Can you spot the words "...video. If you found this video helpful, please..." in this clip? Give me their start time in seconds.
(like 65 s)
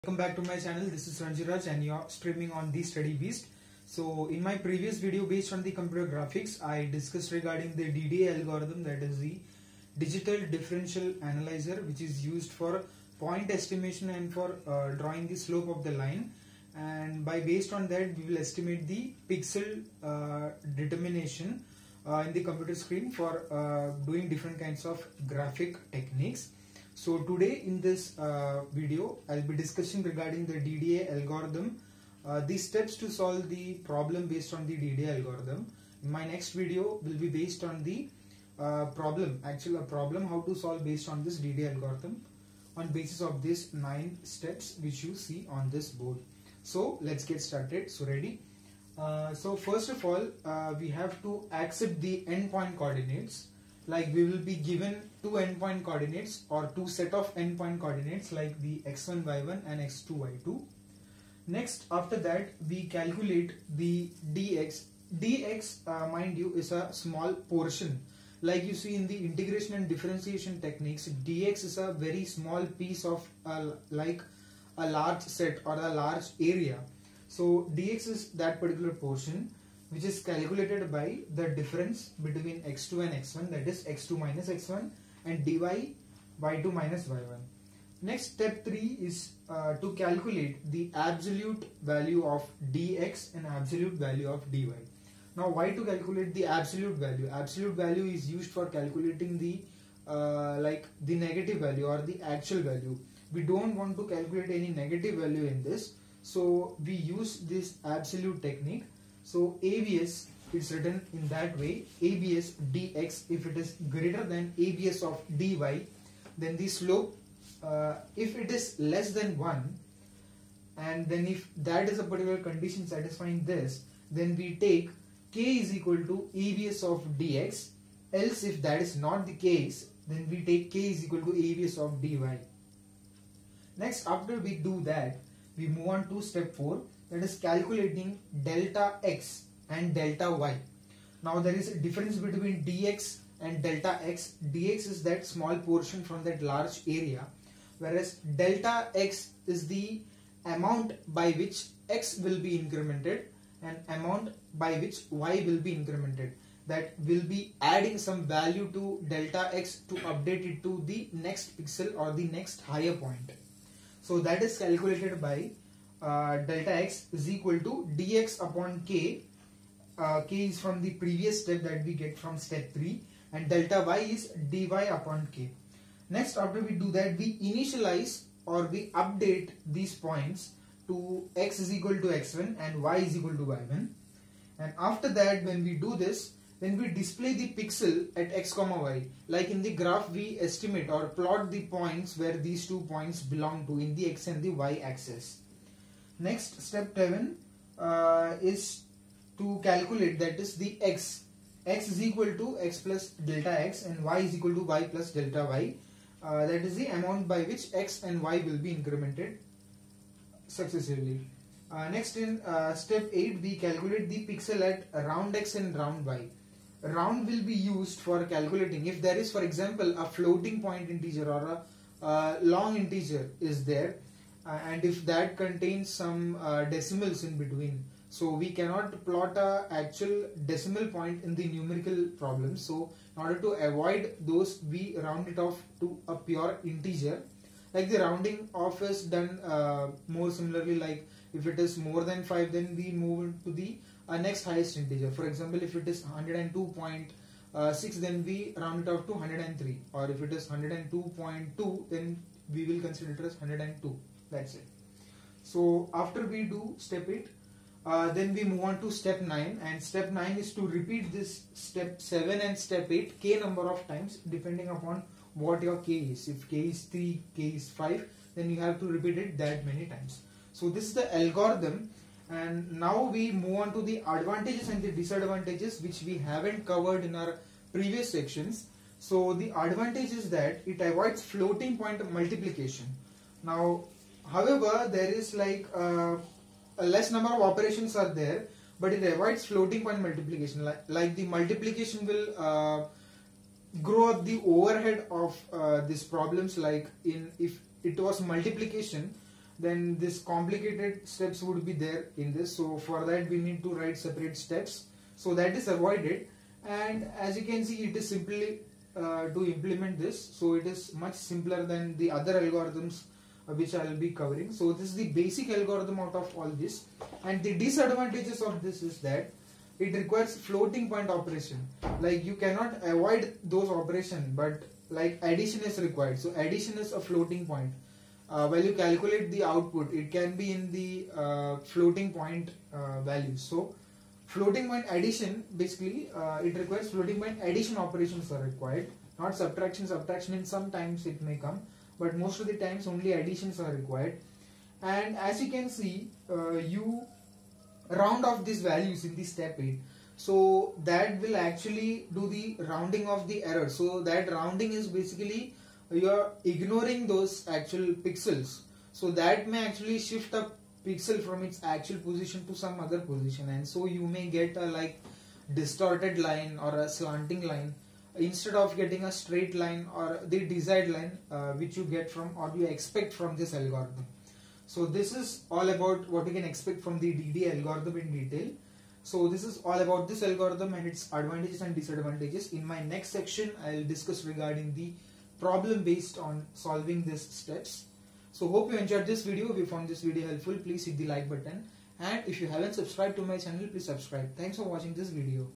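389 s.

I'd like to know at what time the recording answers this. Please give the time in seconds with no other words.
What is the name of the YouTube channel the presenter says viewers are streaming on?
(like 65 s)
2 s.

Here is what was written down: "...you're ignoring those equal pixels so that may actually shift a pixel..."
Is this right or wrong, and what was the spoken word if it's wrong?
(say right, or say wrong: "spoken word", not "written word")
wrong: "actual", not "equal".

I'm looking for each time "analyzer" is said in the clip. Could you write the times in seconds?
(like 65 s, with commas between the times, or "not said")
11 s.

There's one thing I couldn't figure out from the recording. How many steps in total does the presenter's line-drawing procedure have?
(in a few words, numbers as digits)
9.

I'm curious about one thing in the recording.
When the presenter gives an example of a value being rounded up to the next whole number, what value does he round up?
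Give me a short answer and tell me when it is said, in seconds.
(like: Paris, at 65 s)
102.6, at 246 s.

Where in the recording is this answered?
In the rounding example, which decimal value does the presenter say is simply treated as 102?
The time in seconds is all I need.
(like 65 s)
250 s.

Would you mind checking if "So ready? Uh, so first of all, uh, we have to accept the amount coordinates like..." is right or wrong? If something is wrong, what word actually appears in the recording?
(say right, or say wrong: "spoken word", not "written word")
wrong: "endpoint", not "amount".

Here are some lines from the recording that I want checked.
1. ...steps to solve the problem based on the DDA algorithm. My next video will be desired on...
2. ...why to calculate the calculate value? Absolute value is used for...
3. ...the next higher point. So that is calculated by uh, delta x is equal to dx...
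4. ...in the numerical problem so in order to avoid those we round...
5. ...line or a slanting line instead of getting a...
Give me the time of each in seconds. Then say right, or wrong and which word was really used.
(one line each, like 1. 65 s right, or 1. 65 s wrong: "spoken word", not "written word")
1. 32 s wrong: "based", not "desired"
2. 95 s wrong: "absolute", not "calculate"
3. 162 s right
4. 231 s right
5. 366 s right.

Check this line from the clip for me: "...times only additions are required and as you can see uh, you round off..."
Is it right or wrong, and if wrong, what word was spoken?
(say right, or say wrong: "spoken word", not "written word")
right.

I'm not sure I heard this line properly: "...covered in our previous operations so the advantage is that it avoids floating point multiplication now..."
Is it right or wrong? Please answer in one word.
wrong.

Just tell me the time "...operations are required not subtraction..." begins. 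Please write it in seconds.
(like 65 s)
337 s.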